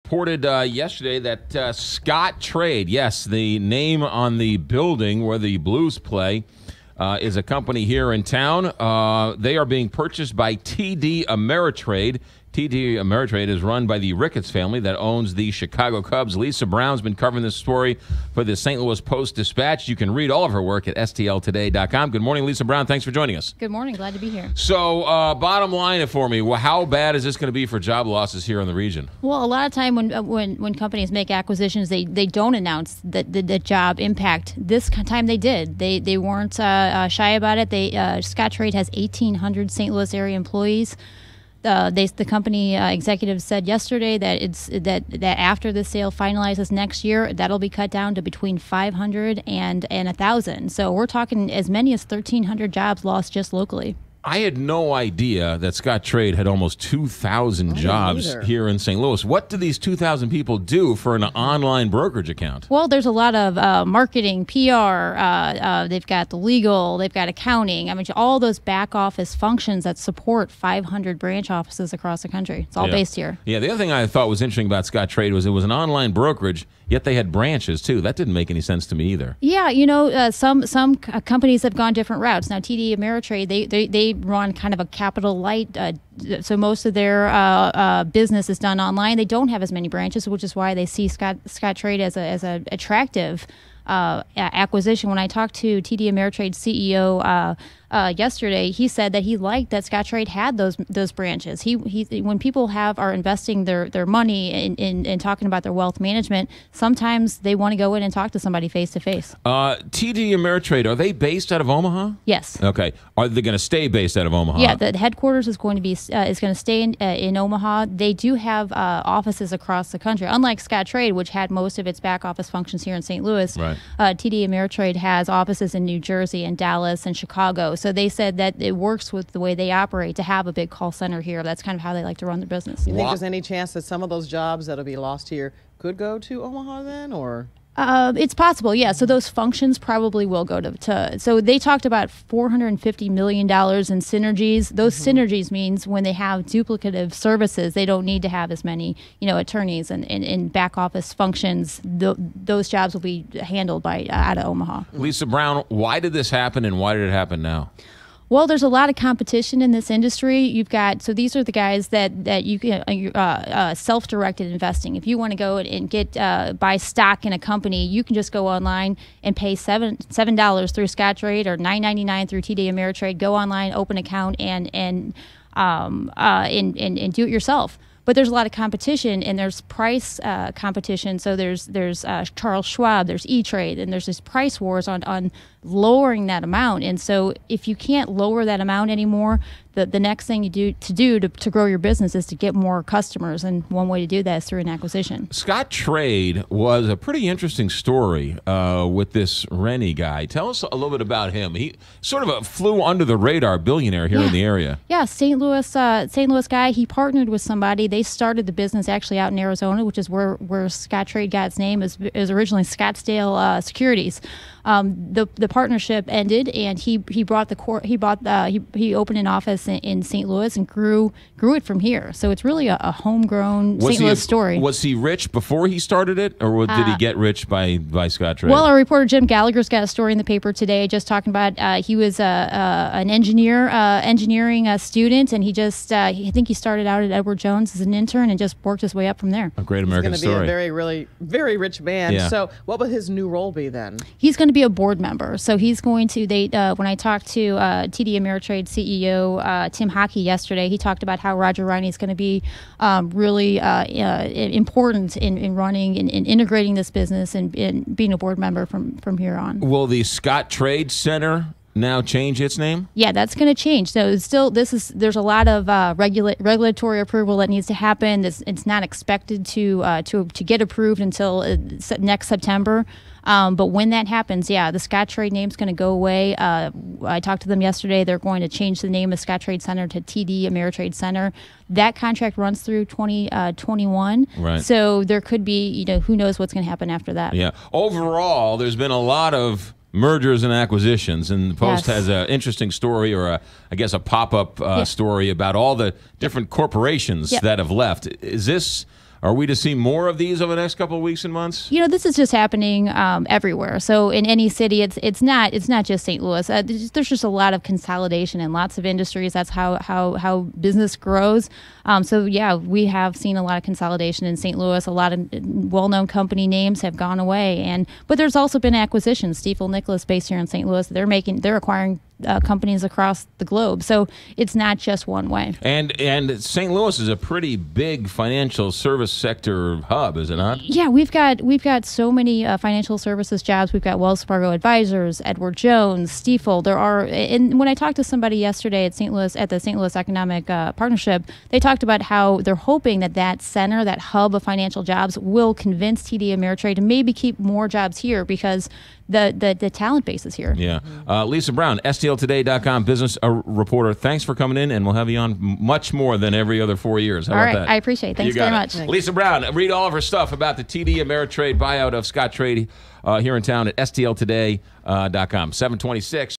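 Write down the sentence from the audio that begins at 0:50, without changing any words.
So we're talking as many as 1,300 jobs lost just locally.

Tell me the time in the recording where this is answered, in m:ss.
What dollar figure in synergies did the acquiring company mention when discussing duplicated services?
2:22.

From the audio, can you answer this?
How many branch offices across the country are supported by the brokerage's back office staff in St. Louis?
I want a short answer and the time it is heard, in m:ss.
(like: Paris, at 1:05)
500, at 1:10.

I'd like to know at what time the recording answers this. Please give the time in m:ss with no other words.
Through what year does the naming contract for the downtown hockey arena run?
4:42.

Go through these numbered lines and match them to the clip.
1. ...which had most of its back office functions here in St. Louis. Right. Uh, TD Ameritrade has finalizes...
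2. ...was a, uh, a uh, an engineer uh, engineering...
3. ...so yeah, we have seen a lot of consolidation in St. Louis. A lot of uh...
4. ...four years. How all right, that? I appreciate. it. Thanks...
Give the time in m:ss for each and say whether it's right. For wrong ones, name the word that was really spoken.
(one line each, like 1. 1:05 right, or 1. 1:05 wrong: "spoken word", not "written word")
1. 2:01 wrong: "offices", not "finalizes"
2. 3:51 right
3. 5:12 right
4. 5:56 right.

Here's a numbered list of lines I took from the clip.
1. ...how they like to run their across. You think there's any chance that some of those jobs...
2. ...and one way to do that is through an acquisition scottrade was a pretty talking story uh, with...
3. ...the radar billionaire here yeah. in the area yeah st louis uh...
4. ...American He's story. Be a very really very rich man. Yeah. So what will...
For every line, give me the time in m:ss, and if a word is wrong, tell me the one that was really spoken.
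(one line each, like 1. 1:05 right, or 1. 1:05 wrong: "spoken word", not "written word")
1. 2:11 wrong: "business", not "across"
2. 3:13 wrong: "interesting", not "talking"
3. 3:23 right
4. 3:59 right.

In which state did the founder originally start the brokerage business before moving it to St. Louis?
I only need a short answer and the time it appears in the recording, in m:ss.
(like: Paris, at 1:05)
Arizona, at 3:29.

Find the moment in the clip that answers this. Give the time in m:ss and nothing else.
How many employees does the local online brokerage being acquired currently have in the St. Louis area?
0:38.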